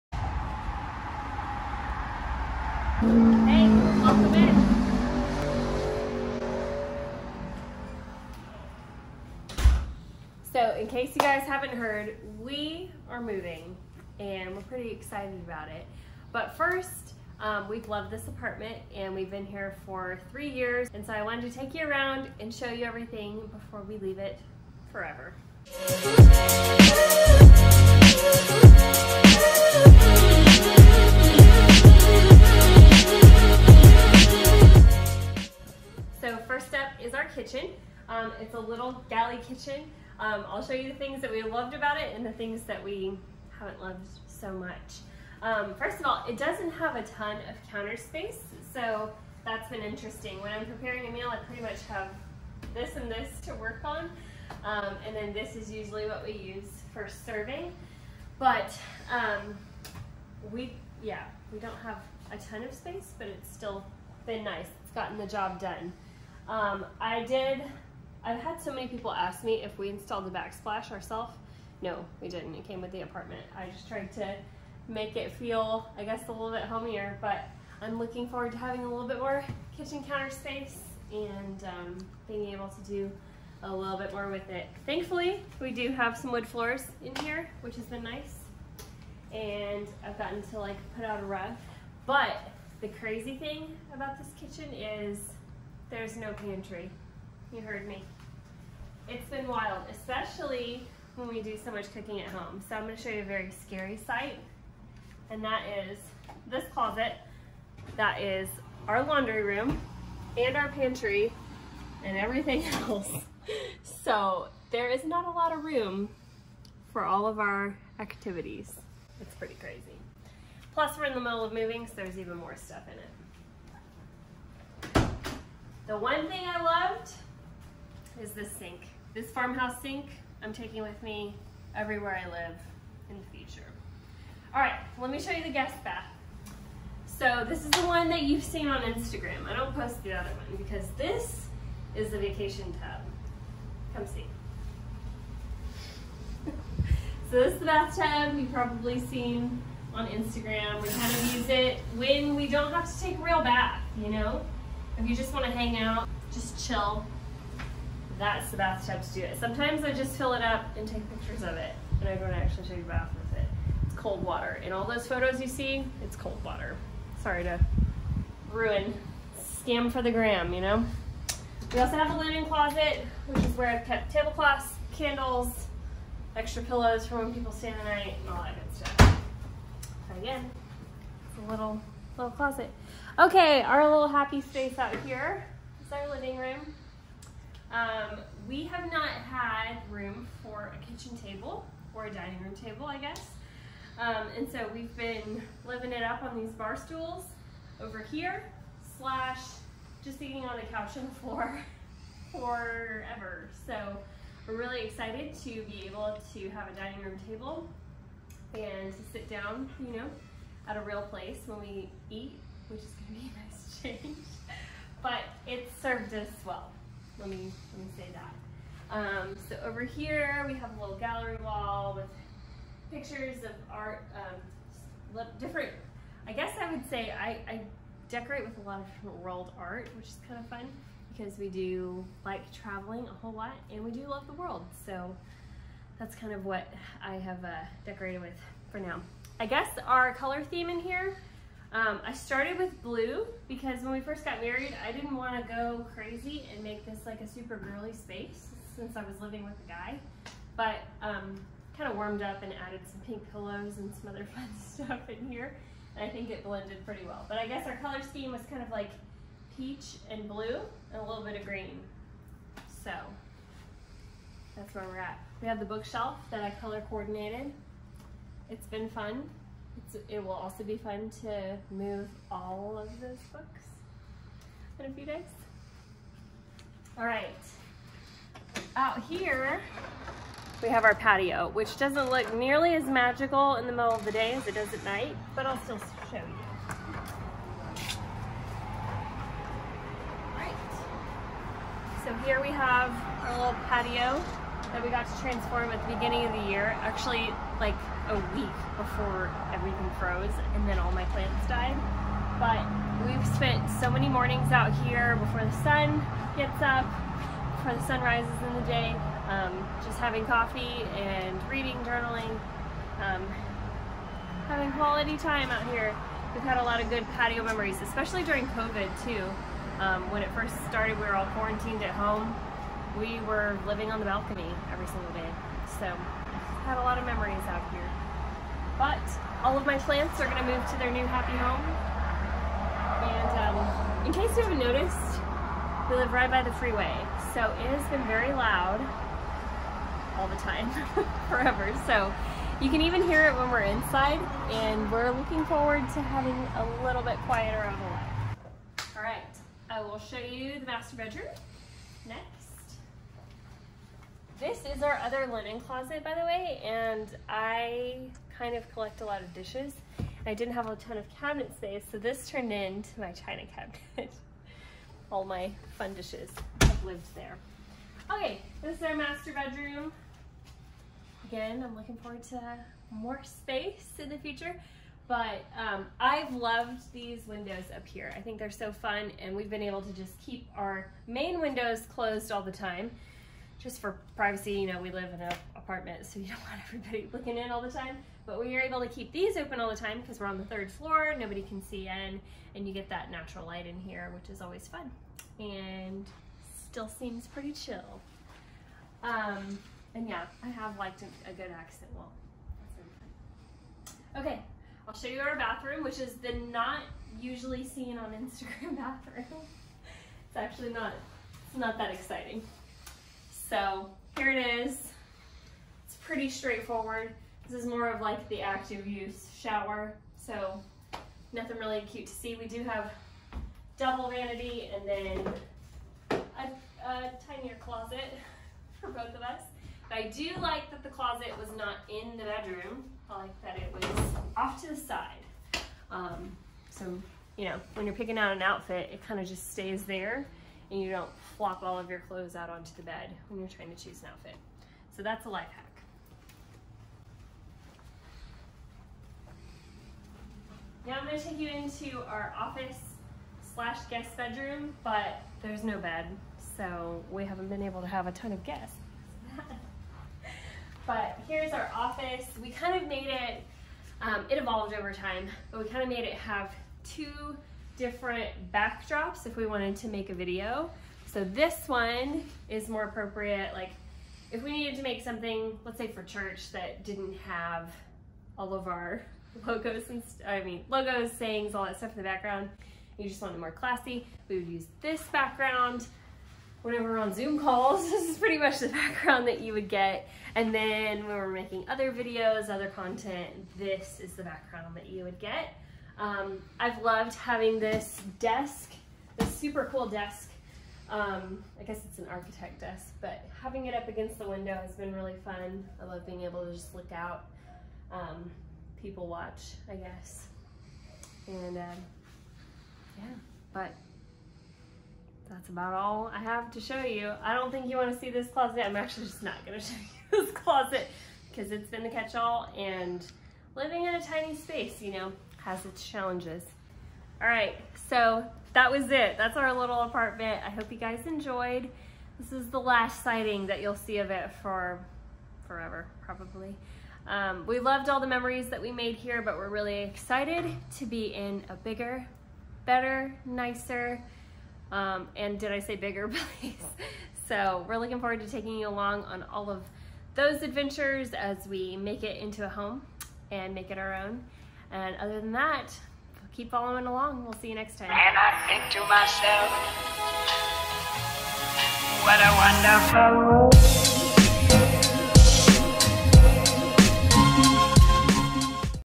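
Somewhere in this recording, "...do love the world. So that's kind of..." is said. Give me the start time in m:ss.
3:53.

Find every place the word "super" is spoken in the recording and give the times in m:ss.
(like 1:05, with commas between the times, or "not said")
4:07, 8:19.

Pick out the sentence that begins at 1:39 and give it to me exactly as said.
It's been wild, especially when we do so much cooking at home.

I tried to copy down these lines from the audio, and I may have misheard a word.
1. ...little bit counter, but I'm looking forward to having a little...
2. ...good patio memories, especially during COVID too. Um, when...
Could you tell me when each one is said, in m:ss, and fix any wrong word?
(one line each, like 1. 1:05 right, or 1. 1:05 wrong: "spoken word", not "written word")
1. 1:16 wrong: "homier", not "counter"
2. 5:16 right.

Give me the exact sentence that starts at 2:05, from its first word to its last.
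The one thing I loved is this sink.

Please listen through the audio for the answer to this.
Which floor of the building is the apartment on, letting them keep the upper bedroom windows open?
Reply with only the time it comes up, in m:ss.
6:30.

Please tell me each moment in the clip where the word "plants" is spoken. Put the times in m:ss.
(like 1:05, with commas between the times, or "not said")
5:01, 5:29.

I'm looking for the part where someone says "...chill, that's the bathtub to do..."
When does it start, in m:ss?
2:36.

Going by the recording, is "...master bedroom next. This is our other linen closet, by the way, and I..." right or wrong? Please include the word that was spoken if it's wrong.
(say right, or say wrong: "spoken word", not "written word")
right.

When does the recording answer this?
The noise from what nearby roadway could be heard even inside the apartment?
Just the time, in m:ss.
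5:36.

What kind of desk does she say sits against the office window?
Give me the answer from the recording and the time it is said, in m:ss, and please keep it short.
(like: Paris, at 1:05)
Architect desk, at 8:22.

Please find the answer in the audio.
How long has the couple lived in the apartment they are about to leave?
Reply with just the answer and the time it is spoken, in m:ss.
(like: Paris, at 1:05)
3 years, at 0:20.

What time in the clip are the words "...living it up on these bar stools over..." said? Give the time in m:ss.
3:15.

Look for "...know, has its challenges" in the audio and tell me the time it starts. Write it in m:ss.
8:44.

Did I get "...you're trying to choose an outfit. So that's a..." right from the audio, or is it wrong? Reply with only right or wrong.
right.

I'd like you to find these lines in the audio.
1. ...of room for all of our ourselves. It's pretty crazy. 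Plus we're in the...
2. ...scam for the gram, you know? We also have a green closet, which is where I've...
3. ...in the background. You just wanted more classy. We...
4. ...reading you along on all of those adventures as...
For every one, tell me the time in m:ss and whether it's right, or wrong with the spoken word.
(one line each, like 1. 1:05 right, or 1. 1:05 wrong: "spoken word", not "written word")
1. 1:55 wrong: "activities", not "ourselves"
2. 2:49 wrong: "linen", not "green"
3. 8:01 right
4. 9:08 wrong: "taking", not "reading".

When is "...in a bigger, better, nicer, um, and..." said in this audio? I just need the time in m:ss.
9:01.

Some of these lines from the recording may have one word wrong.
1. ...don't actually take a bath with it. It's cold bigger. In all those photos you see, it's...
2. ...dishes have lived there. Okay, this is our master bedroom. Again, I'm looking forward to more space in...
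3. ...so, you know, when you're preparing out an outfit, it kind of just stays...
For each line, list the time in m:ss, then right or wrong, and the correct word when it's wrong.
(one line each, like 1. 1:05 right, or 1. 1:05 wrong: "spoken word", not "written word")
1. 2:42 wrong: "water", not "bigger"
2. 6:05 right
3. 7:16 wrong: "picking", not "preparing".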